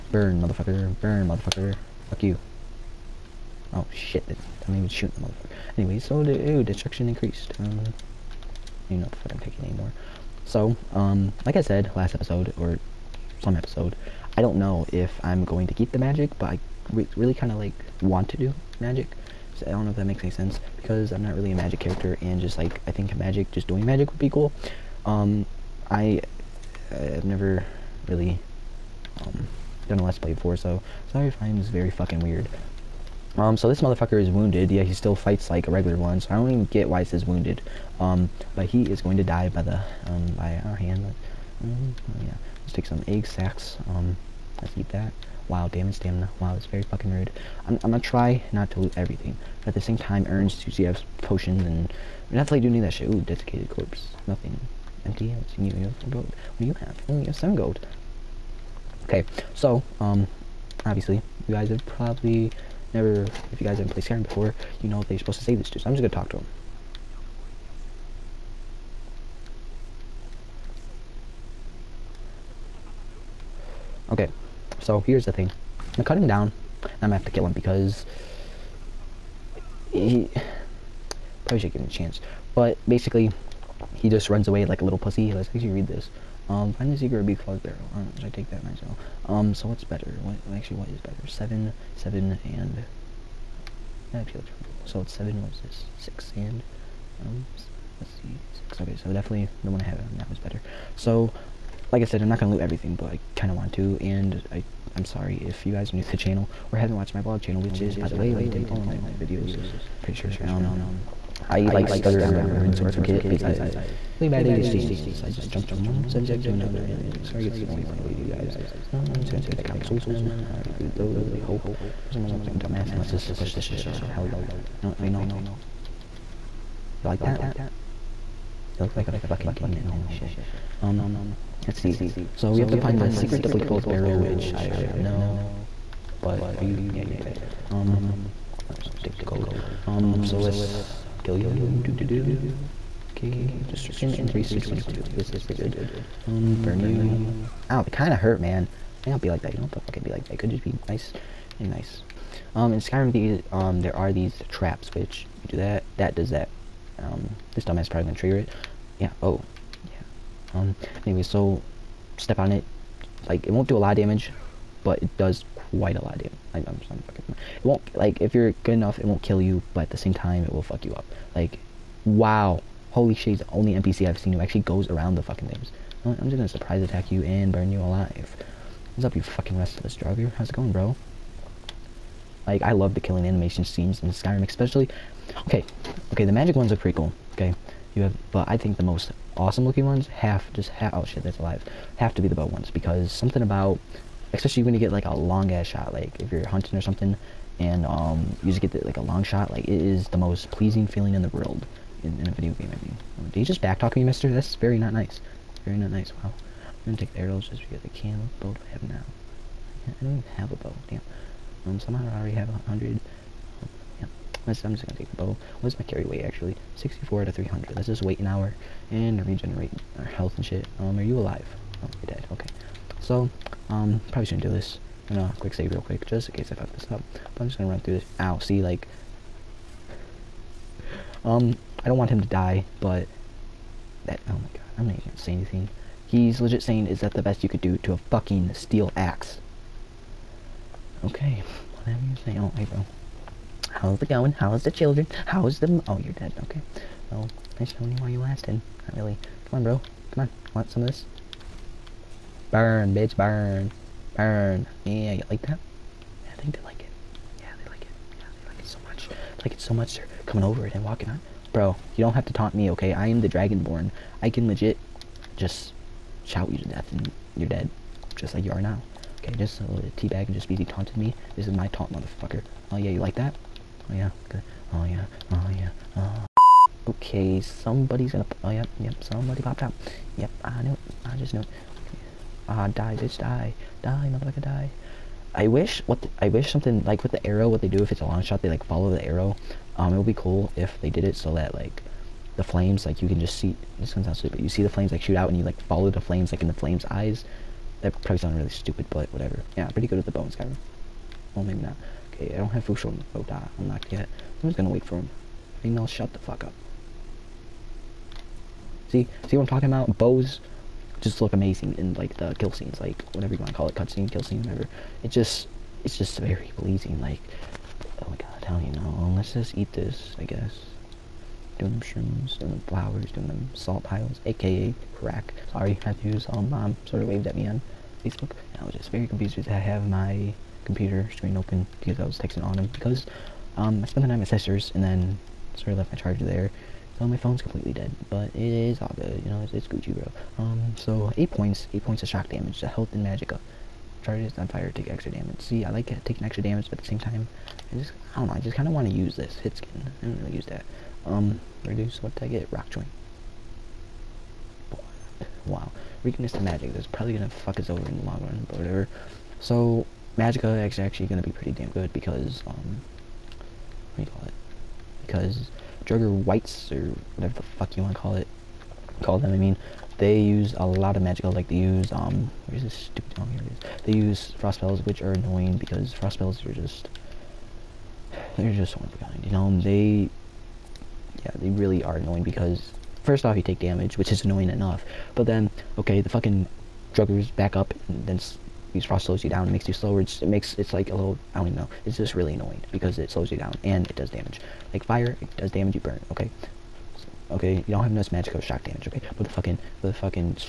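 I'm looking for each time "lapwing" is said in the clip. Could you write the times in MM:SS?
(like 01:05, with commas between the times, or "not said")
not said.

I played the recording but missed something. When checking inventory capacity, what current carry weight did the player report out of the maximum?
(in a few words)
64.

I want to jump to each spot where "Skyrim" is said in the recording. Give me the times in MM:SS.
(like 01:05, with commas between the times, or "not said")
01:04, 02:32, 03:04, 05:00.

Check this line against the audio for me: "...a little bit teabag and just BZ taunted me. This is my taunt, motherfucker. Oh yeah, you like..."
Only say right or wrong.
right.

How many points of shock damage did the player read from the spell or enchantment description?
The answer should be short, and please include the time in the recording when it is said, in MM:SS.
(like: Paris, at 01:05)
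8, at 05:41.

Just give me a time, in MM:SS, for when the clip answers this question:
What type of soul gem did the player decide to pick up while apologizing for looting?
01:59.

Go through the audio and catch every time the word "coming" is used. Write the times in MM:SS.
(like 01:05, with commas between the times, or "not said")
04:20.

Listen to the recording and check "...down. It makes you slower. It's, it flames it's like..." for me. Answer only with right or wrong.
wrong.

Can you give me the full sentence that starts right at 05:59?
So, Magicka is actually gonna be pretty damn good because, um, what do you call it?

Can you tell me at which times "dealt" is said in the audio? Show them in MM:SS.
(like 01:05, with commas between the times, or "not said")
not said.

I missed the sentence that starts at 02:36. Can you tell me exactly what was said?
Um, this dumbass probably gonna trigger it.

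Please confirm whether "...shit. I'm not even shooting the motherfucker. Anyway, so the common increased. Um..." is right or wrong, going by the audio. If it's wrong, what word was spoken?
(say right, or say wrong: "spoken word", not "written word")
wrong: "destruction", not "common".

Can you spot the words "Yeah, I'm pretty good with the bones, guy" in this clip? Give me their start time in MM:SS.
04:59.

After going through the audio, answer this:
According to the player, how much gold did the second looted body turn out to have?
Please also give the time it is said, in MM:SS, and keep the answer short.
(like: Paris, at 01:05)
7, at 00:57.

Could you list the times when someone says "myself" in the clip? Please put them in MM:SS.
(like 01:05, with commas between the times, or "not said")
01:28.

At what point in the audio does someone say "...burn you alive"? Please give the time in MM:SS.
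02:57.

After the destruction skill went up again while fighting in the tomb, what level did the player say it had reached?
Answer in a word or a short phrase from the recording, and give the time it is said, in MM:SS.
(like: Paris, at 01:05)
22, at 02:24.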